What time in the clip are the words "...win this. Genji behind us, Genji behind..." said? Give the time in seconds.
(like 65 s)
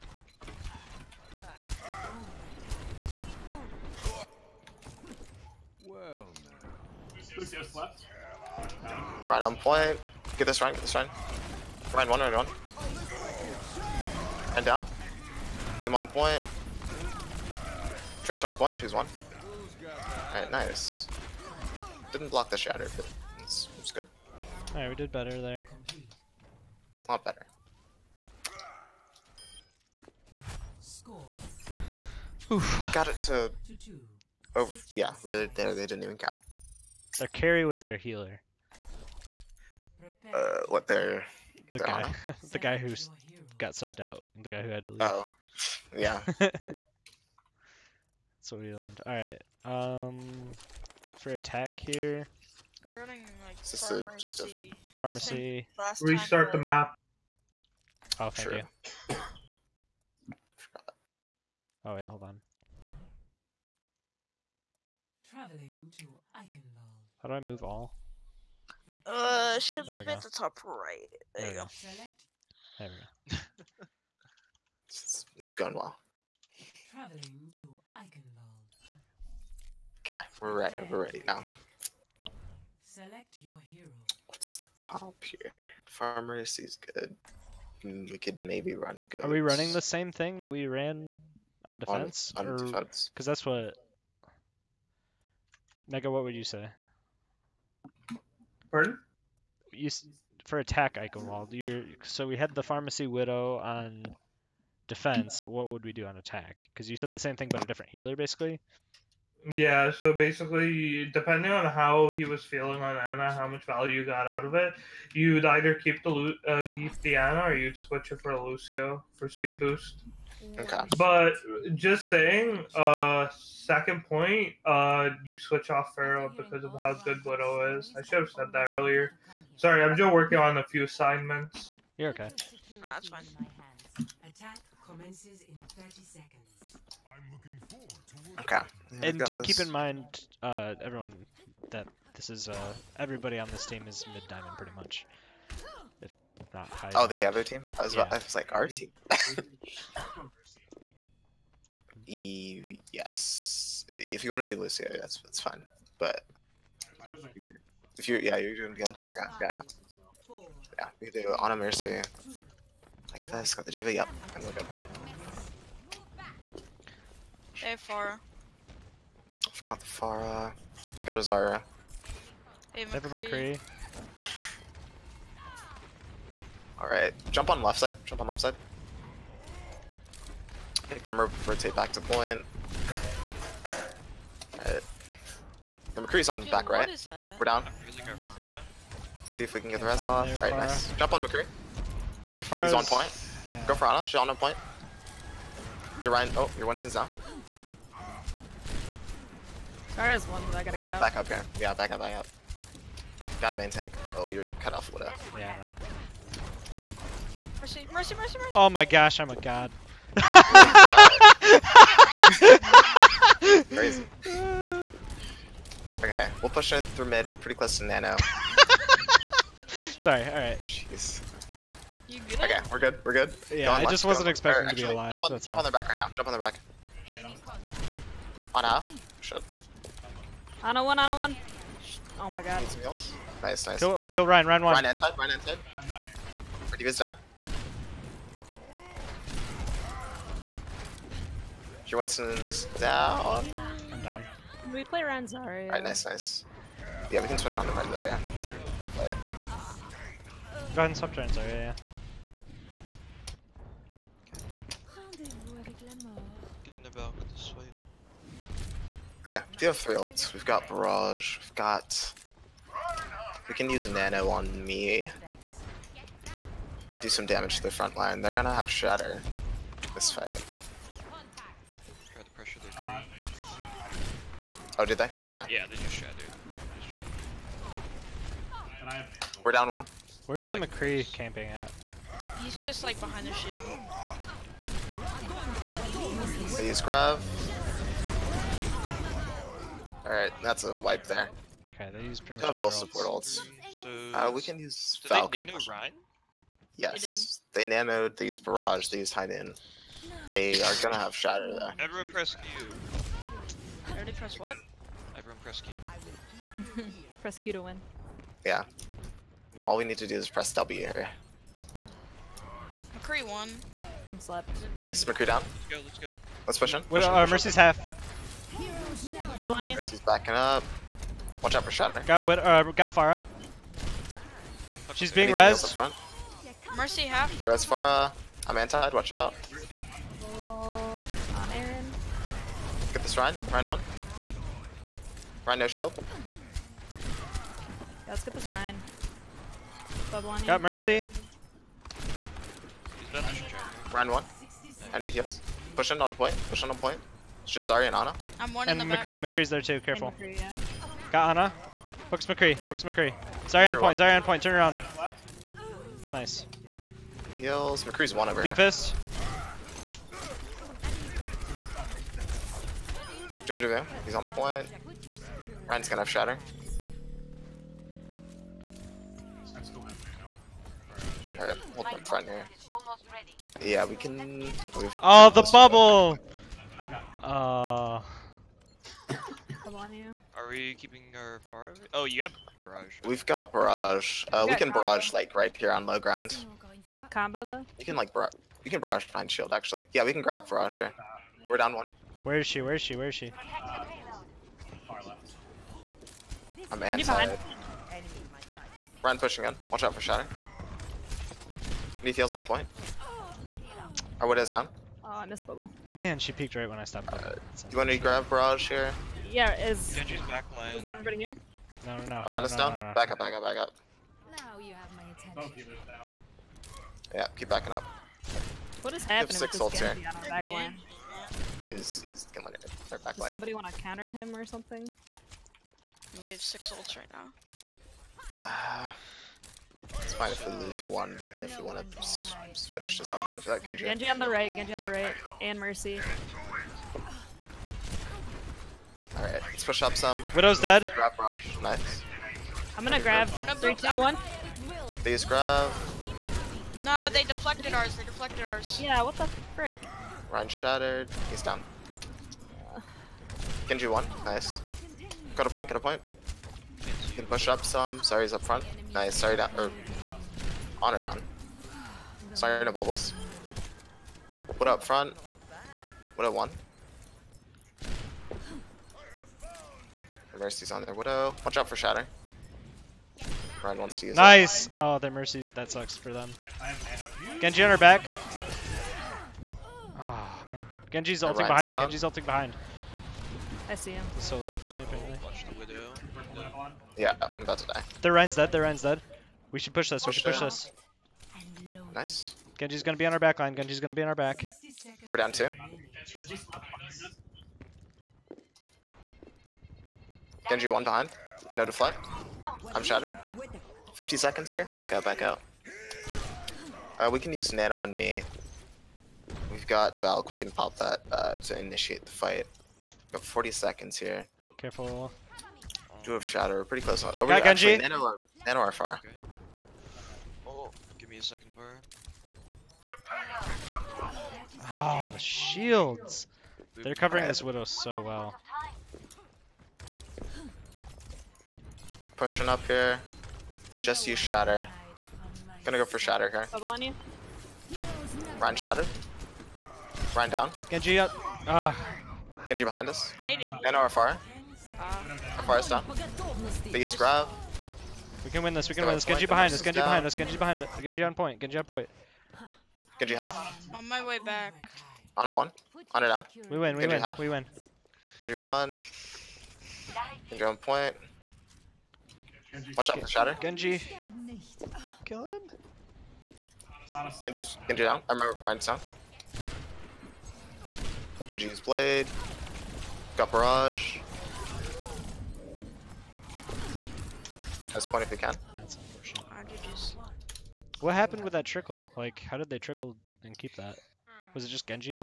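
548 s.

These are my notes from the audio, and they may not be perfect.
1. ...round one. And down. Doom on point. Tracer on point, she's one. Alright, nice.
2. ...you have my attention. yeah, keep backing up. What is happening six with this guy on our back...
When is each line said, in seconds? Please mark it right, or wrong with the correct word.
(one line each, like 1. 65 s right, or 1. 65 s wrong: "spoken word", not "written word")
1. 12 s right
2. 414 s right.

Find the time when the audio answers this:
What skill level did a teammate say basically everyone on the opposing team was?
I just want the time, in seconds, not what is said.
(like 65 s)
144 s.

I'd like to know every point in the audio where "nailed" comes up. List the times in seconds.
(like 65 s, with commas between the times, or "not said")
not said.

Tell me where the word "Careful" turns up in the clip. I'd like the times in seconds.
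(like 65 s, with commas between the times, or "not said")
349 s, 514 s.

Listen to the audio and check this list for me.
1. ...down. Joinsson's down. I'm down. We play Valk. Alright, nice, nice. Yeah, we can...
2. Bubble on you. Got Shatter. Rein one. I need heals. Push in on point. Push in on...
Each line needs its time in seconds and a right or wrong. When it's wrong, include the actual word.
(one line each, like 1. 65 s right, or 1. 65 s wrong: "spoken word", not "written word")
1. 236 s wrong: "Ranzari", not "Valk"
2. 340 s wrong: "Mercy", not "Shatter".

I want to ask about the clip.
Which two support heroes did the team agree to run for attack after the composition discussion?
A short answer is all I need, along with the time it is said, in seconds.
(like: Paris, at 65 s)
Ana Mercy, at 161 s.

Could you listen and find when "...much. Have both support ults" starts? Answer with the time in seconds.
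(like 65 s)
292 s.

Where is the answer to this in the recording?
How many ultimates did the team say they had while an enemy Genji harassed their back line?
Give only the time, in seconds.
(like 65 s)
426 s.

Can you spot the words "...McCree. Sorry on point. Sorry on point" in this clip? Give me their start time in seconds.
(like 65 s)
352 s.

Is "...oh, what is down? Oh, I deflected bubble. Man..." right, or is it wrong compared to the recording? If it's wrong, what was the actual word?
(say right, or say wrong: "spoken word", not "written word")
wrong: "missed", not "deflected".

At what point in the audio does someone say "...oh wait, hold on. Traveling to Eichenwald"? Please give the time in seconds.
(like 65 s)
61 s.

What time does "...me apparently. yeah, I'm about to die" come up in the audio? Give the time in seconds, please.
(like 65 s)
484 s.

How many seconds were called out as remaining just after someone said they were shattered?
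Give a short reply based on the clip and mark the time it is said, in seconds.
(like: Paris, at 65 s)
50, at 503 s.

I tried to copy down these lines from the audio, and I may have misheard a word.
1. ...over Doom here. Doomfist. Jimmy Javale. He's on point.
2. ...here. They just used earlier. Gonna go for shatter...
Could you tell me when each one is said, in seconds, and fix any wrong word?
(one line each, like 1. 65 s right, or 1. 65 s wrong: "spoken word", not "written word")
1. 358 s right
2. 532 s wrong: "shatter", not "earlier".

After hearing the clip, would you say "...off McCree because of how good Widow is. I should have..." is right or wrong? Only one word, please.
wrong.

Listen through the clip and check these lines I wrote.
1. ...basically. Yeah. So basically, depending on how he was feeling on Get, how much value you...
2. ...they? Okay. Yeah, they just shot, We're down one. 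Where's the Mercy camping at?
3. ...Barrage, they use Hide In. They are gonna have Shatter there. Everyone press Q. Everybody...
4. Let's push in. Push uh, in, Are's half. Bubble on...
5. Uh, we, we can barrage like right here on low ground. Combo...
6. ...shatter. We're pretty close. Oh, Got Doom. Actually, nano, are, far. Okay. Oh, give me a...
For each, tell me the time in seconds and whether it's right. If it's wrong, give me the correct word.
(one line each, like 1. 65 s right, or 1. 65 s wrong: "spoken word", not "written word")
1. 108 s wrong: "Ana", not "Get"
2. 274 s wrong: "McCree", not "Mercy"
3. 298 s right
4. 316 s wrong: "Mercy", not "Are"
5. 384 s right
6. 516 s wrong: "Genji", not "Doom".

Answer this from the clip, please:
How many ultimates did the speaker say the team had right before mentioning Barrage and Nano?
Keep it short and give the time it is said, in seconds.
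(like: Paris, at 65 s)
3, at 259 s.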